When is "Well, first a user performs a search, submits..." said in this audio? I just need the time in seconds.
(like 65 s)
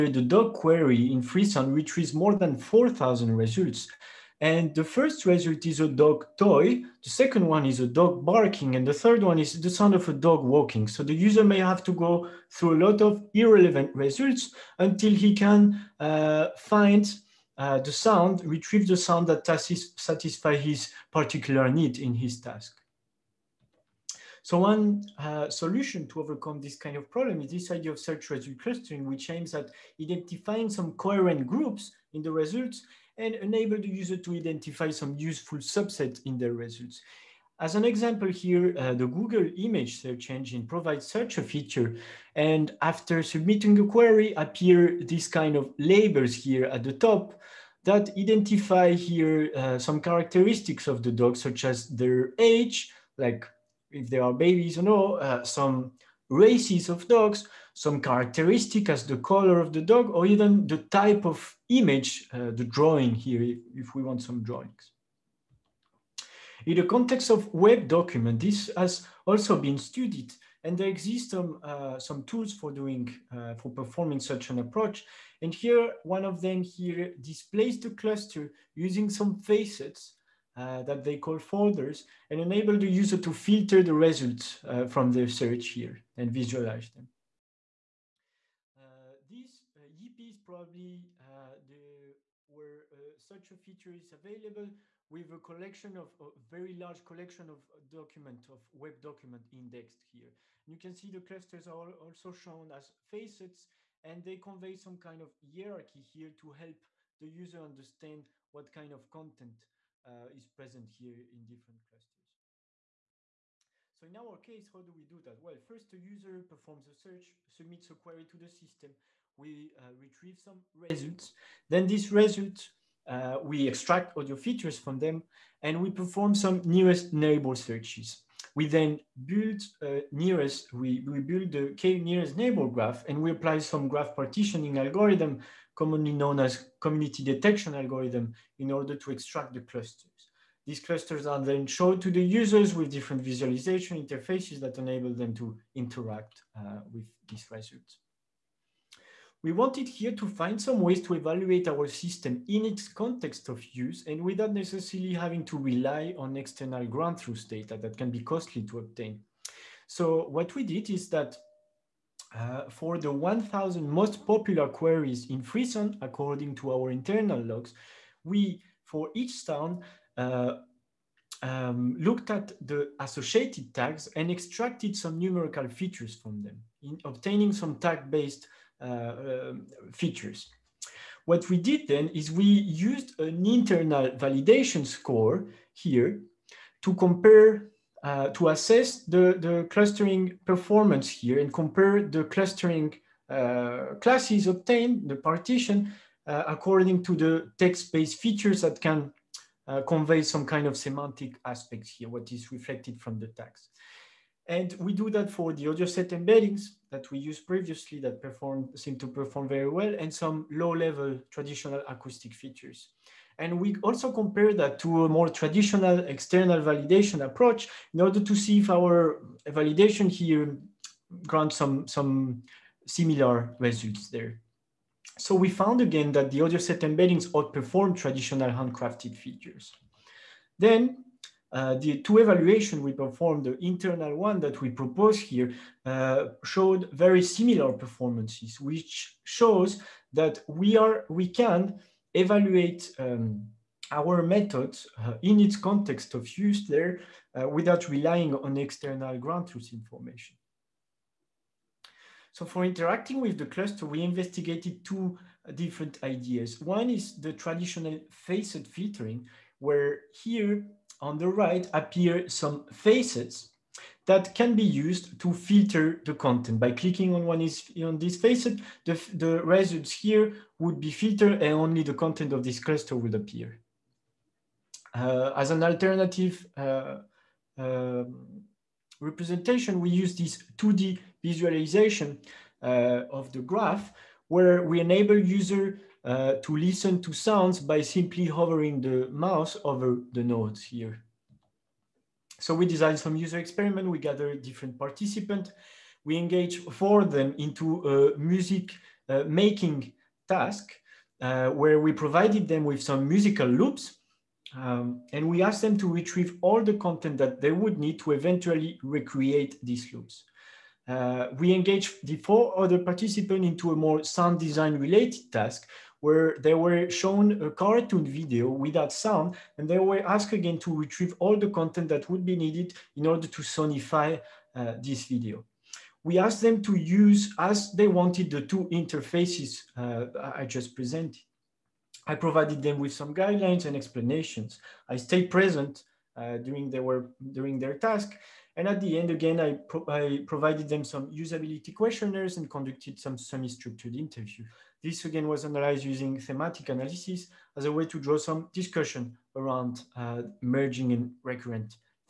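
115 s.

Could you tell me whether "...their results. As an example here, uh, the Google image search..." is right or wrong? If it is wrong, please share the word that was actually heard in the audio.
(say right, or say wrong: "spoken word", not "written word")
right.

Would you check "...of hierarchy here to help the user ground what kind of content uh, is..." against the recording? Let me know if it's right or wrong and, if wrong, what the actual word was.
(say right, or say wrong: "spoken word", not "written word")
wrong: "understand", not "ground".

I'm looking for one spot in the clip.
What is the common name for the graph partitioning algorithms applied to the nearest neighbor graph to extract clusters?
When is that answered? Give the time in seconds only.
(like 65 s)
136 s.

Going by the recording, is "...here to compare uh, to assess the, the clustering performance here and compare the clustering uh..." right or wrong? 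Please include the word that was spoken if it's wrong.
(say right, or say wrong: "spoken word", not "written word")
right.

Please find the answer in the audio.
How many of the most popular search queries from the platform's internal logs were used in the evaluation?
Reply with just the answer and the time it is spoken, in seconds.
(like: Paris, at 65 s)
1,000, at 163 s.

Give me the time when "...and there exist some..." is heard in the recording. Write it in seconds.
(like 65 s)
70 s.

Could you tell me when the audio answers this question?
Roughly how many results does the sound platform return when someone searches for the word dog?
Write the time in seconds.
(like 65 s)
2 s.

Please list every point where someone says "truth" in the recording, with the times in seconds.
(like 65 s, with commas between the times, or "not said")
157 s, 249 s.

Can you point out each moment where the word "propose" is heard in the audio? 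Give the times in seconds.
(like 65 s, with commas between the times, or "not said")
234 s.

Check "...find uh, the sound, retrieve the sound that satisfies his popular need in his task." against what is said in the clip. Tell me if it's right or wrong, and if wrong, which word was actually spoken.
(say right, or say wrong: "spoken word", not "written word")
wrong: "particular", not "popular".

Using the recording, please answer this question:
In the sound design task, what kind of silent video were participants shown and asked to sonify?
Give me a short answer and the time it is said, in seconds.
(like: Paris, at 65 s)
cartoon video, at 317 s.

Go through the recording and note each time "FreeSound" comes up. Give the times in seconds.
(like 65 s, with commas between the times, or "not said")
1 s, 165 s.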